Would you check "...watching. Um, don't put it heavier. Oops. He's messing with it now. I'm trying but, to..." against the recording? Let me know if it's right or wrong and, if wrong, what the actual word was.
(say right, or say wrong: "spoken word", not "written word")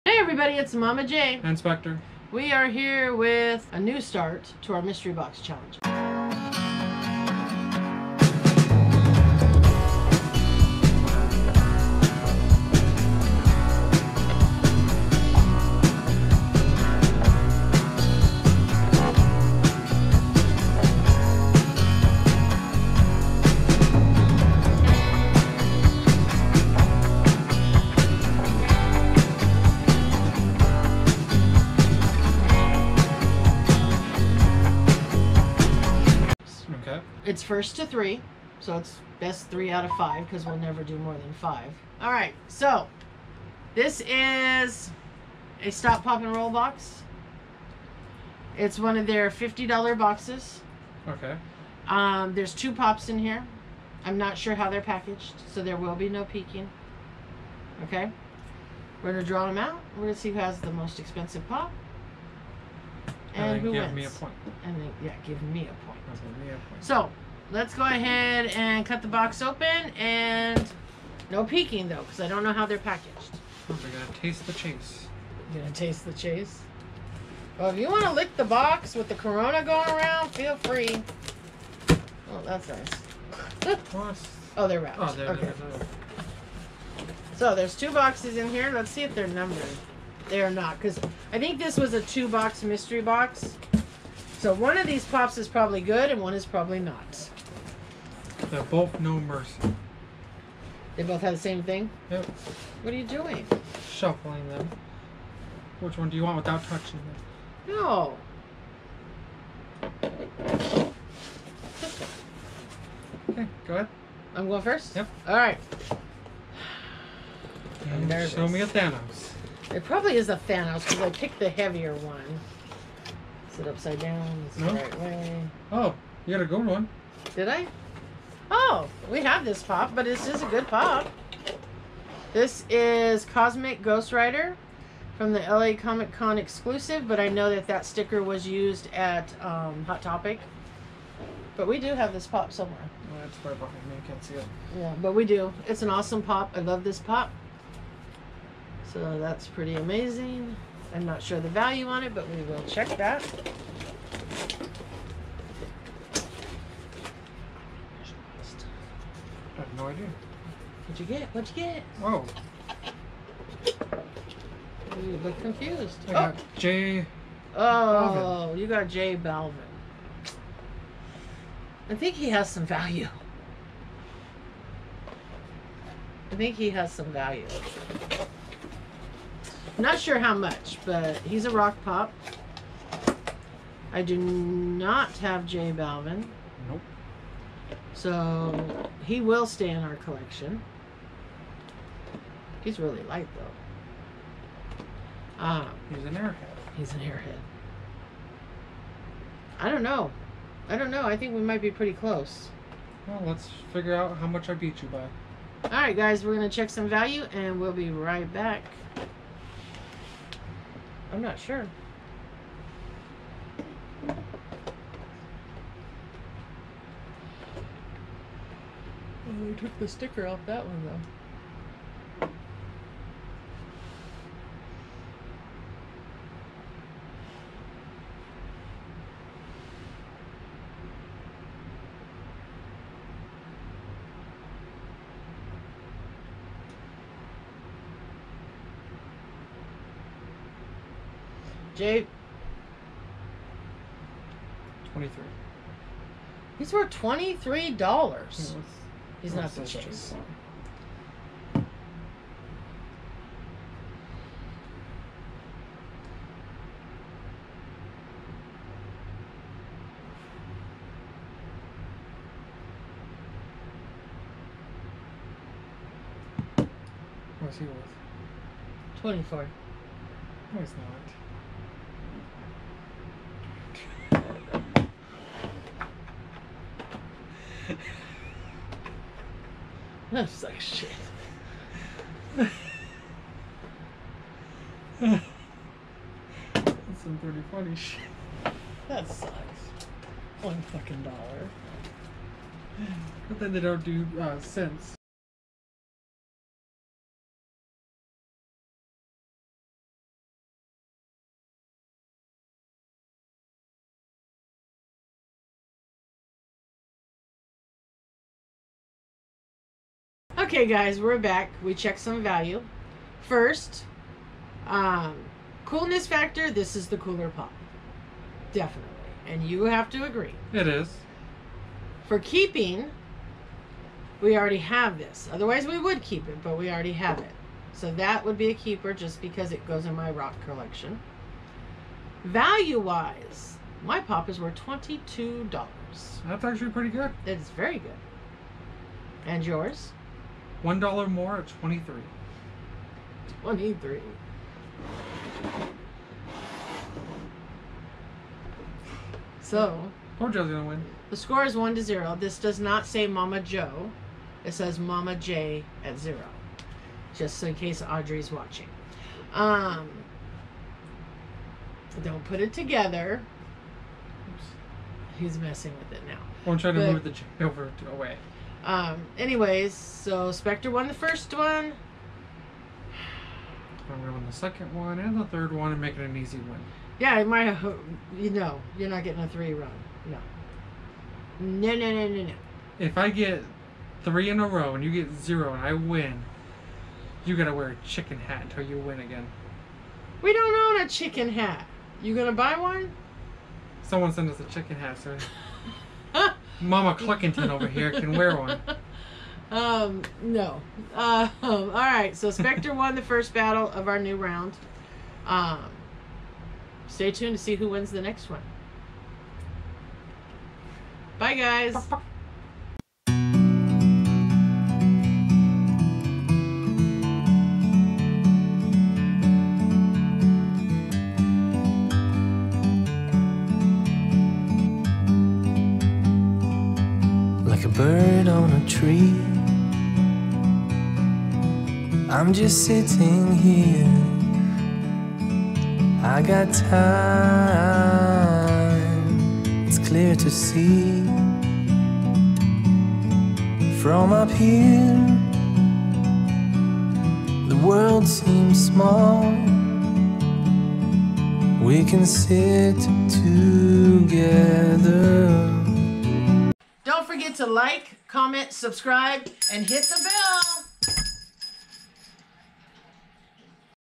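wrong: "together", not "heavier".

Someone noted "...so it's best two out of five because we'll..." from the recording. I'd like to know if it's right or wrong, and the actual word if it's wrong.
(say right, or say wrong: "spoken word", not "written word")
wrong: "three", not "two".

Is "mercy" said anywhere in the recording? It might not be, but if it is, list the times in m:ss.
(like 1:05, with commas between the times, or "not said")
1:39.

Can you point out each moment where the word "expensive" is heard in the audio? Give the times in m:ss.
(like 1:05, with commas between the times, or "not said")
1:00.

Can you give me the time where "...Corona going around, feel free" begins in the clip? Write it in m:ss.
1:19.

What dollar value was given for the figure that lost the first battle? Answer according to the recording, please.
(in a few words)
$22.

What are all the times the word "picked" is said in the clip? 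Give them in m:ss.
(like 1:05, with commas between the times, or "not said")
2:01.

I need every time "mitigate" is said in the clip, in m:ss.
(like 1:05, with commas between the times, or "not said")
not said.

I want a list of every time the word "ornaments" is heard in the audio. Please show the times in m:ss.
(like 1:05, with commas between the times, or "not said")
not said.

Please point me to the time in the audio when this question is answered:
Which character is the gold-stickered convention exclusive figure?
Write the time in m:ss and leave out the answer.
2:13.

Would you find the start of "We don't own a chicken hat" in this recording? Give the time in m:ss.
6:30.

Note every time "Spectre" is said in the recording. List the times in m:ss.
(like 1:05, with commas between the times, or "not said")
0:01, 6:10, 6:42.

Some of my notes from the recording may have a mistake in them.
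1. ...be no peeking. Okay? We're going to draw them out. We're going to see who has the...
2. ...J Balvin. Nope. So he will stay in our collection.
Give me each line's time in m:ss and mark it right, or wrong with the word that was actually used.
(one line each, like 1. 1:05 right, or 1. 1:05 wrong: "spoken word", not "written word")
1. 0:55 right
2. 3:05 right.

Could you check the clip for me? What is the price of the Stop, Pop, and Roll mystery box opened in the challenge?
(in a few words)
$50.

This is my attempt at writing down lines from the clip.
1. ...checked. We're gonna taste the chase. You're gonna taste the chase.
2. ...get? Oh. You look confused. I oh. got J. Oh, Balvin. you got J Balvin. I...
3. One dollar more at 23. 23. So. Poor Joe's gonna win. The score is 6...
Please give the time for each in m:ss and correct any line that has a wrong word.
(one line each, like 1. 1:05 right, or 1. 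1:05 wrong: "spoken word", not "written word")
1. 1:12 wrong: "packaged", not "checked"
2. 2:41 right
3. 5:40 wrong: "1", not "6".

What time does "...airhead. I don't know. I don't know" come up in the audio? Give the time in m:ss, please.
3:16.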